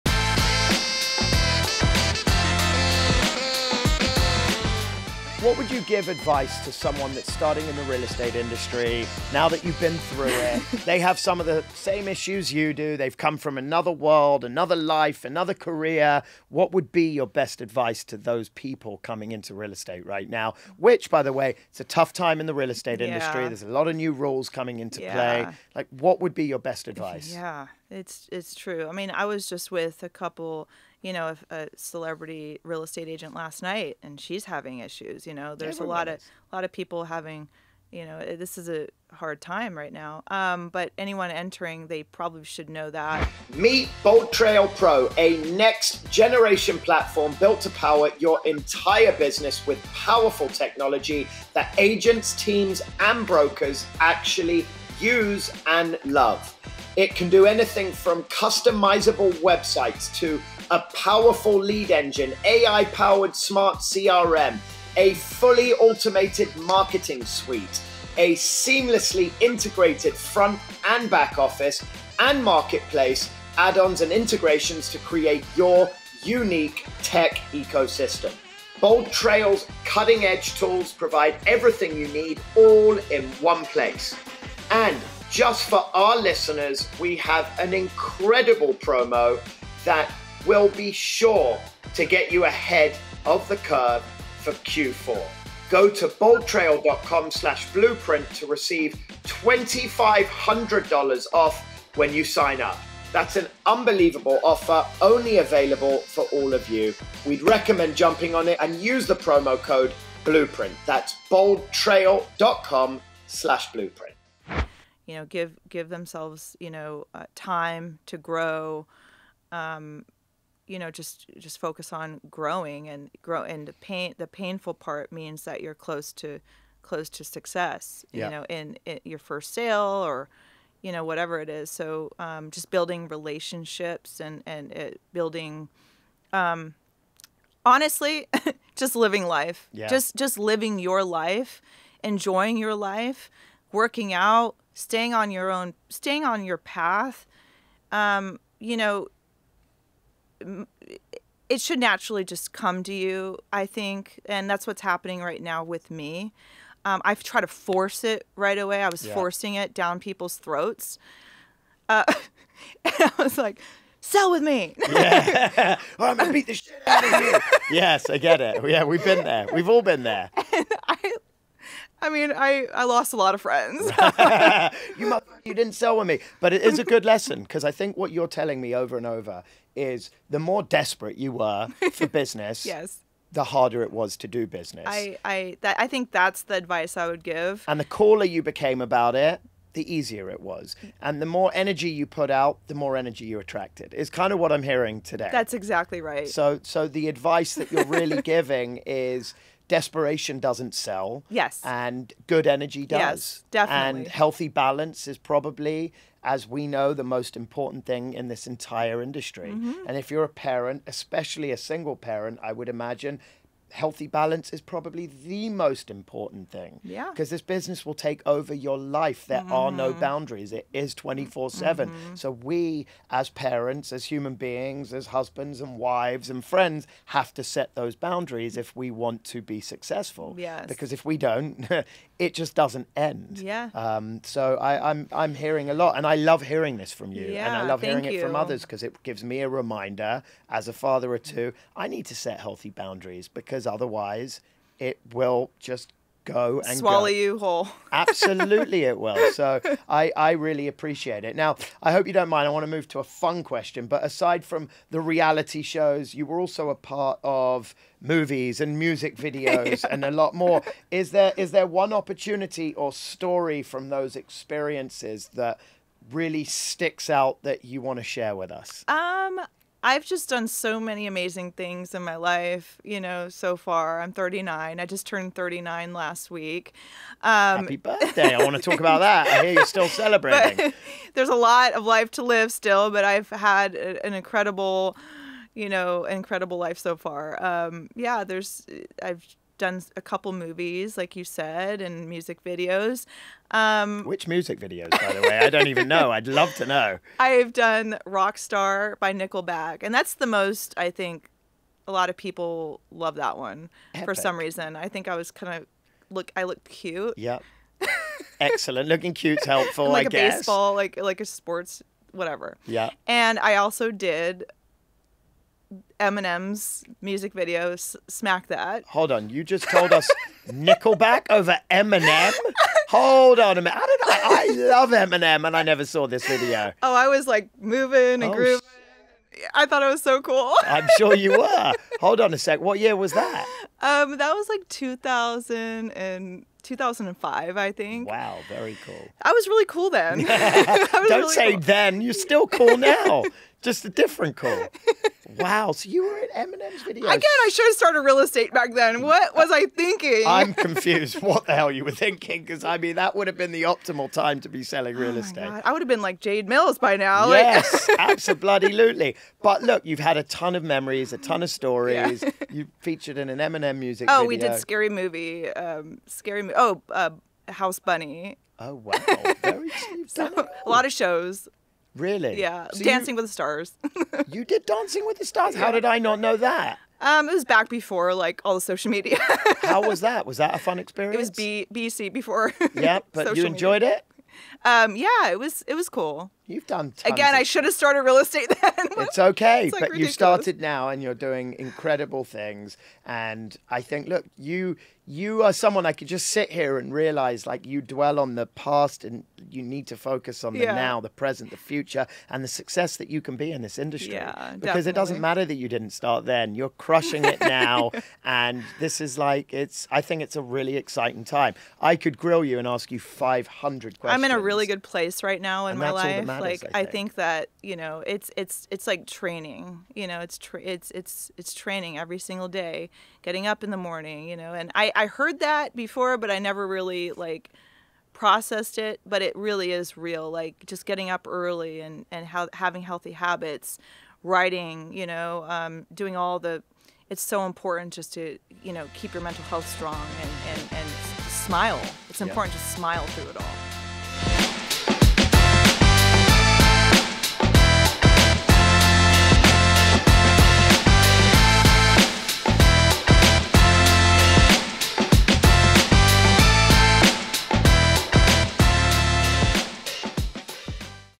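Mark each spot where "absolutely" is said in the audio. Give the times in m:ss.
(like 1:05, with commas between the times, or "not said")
4:07, 5:57.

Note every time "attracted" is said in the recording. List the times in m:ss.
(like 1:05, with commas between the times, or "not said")
3:13.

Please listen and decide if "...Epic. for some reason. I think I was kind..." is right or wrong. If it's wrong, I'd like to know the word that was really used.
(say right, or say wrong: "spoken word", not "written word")
right.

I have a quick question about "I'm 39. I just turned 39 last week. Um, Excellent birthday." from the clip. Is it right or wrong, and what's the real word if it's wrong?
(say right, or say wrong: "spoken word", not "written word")
wrong: "Happy", not "Excellent".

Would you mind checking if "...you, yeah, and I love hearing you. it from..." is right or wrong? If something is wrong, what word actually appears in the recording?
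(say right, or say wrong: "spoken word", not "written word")
right.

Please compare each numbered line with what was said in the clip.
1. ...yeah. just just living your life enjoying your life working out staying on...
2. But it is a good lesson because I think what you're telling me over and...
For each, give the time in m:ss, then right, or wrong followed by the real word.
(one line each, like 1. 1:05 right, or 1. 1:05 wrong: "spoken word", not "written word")
1. 2:19 right
2. 2:56 right.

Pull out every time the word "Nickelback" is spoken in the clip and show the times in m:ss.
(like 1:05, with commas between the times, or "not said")
4:59, 5:20.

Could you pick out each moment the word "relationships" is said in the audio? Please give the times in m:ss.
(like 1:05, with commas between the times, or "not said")
2:13.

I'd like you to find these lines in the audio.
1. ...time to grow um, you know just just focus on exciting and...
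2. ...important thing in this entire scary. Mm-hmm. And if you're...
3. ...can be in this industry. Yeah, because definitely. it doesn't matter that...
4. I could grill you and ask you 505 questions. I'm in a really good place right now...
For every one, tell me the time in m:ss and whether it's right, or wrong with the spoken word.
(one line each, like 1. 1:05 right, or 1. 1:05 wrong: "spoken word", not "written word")
1. 1:57 wrong: "growing", not "exciting"
2. 3:27 wrong: "industry", not "scary"
3. 6:43 right
4. 6:51 wrong: "500", not "505".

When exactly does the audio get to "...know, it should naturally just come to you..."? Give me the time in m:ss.
2:28.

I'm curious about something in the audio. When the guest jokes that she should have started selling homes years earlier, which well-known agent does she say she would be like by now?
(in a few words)
Jade Mills.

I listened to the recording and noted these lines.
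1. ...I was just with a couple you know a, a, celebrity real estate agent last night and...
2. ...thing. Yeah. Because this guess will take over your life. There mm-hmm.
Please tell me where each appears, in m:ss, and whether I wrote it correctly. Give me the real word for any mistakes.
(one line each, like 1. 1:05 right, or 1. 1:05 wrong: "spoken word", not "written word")
1. 0:29 right
2. 3:36 wrong: "business", not "guess".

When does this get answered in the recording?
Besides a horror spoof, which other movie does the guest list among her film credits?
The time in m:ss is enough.
6:07.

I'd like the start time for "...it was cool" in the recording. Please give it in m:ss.
6:25.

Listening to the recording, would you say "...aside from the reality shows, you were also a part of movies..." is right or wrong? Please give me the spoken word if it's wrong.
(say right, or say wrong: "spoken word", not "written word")
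right.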